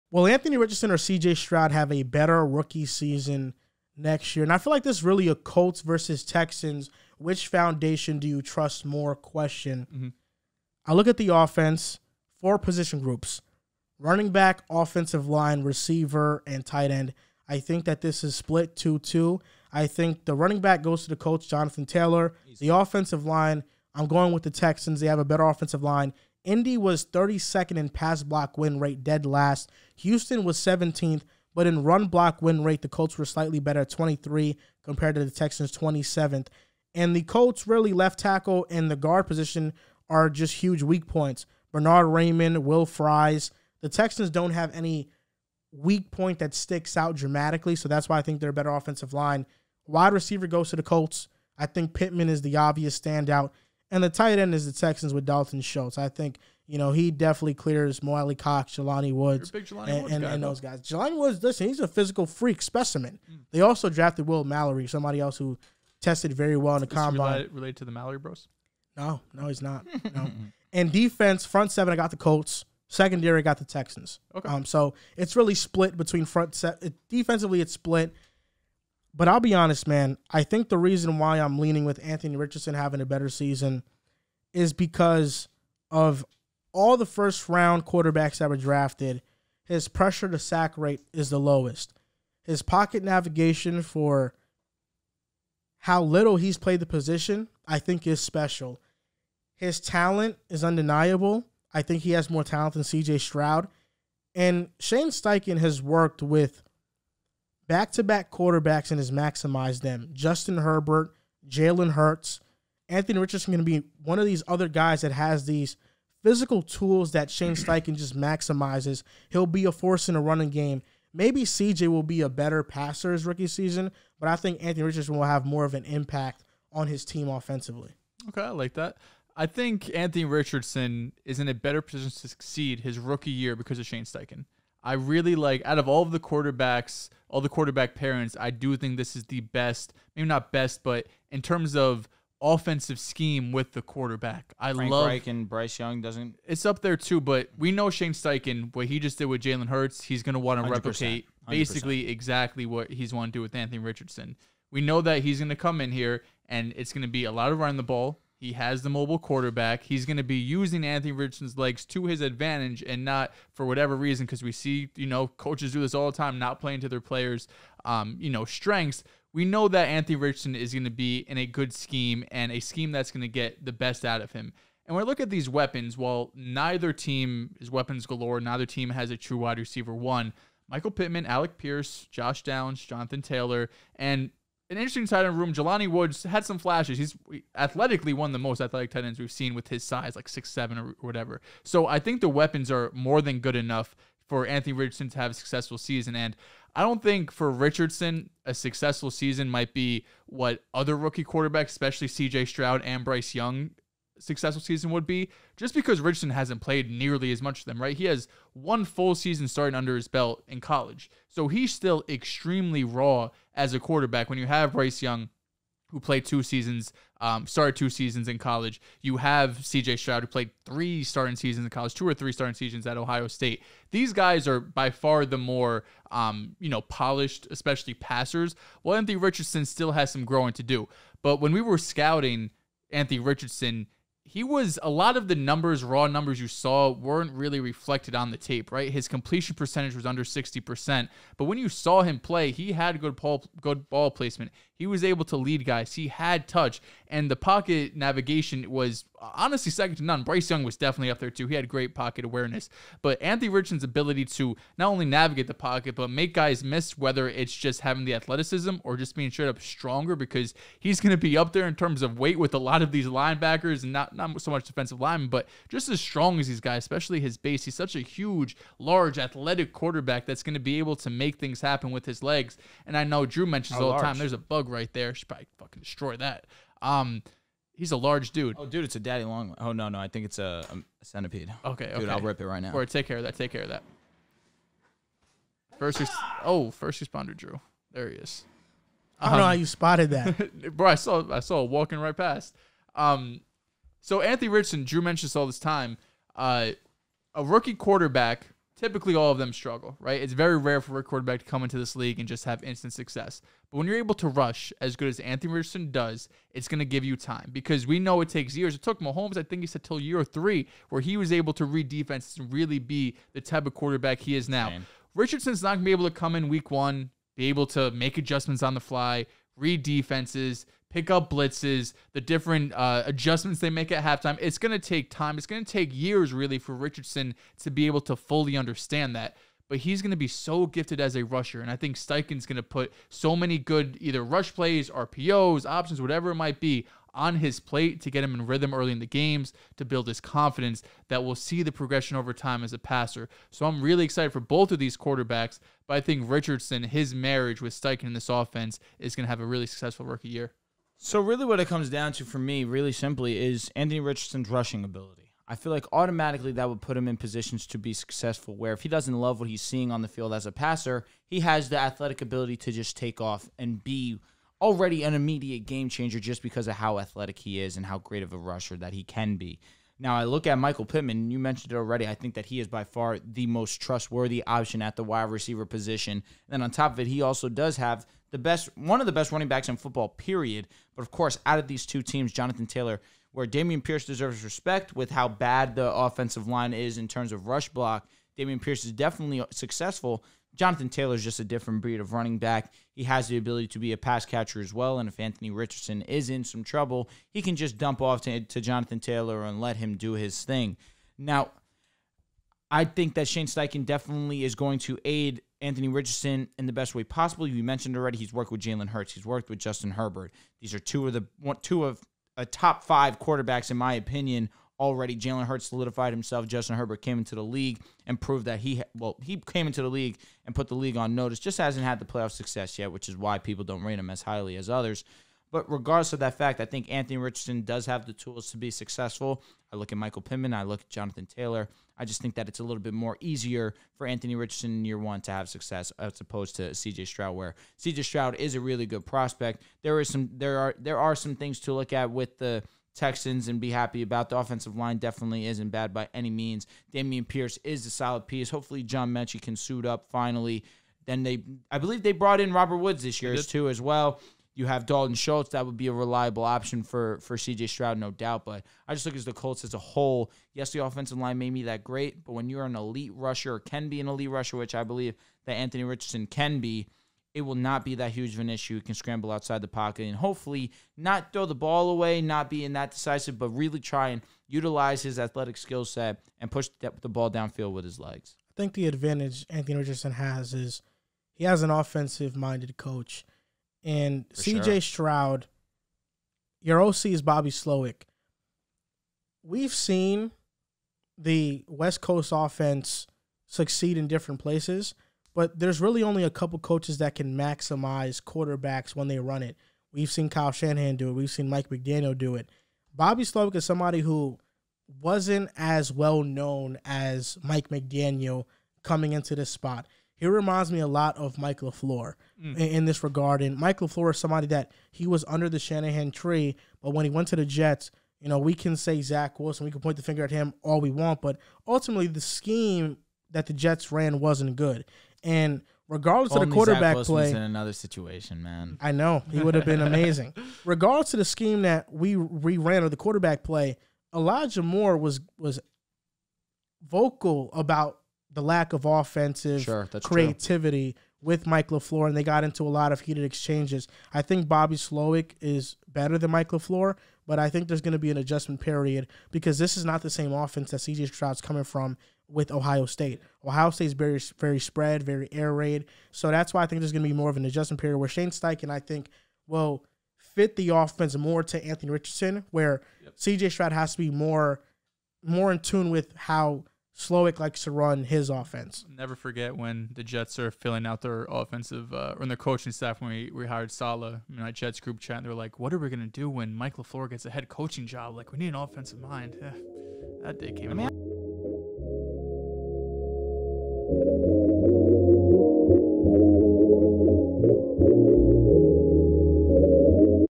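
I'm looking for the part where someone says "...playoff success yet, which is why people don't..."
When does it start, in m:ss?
7:02.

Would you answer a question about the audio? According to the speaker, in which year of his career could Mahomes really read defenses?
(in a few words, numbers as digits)
year three.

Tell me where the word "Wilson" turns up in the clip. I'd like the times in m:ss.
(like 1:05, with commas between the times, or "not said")
8:39.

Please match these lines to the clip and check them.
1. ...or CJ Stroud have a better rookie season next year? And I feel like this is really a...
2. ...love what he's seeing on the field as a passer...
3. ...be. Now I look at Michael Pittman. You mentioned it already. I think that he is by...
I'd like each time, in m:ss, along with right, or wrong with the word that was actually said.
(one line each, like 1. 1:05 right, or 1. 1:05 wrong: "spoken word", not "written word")
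1. 0:00 right
2. 5:59 right
3. 6:09 right.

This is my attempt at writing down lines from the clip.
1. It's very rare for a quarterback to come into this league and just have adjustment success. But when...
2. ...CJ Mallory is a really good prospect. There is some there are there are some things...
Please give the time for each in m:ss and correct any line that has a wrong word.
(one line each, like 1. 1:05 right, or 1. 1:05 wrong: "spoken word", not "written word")
1. 5:00 wrong: "instant", not "adjustment"
2. 7:17 wrong: "Stroud", not "Mallory".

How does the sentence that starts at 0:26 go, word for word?
Indy was 32nd in pass block win rate, dead last.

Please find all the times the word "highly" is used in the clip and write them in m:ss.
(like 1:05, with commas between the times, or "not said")
7:04.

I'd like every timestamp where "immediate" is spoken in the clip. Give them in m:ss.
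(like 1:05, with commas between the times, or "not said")
6:05.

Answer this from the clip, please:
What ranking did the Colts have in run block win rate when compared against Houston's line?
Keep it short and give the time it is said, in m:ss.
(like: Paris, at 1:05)
23, at 0:33.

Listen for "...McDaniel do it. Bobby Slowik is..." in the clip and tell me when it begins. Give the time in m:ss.
8:21.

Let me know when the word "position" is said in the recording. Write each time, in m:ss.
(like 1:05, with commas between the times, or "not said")
0:12, 0:39, 1:36, 2:11, 5:57, 6:15.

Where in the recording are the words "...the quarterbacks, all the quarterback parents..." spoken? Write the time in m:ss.
2:16.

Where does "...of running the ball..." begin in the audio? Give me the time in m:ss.
2:37.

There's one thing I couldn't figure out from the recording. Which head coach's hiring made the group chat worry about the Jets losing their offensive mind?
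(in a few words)
Saleh.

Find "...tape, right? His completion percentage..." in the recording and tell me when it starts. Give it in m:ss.
3:58.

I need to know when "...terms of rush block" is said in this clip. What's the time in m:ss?
6:27.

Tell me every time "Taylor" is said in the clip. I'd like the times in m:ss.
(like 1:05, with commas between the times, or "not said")
0:21, 3:03, 6:22, 6:30, 6:38, 7:11.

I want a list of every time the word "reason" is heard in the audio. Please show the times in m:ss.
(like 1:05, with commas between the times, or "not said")
1:20, 2:43.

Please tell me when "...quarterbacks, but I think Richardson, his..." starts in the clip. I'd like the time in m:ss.
5:44.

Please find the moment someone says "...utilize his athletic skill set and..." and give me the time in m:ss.
7:54.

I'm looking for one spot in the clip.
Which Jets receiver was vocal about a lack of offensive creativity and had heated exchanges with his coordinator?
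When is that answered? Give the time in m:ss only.
8:54.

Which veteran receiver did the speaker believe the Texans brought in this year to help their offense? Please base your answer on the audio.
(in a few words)
Robert Woods.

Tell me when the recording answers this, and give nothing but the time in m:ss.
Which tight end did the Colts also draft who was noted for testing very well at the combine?
1:04.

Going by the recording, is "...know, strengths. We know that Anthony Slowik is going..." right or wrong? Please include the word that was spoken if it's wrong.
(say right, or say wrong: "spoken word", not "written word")
wrong: "Richardson", not "Slowik".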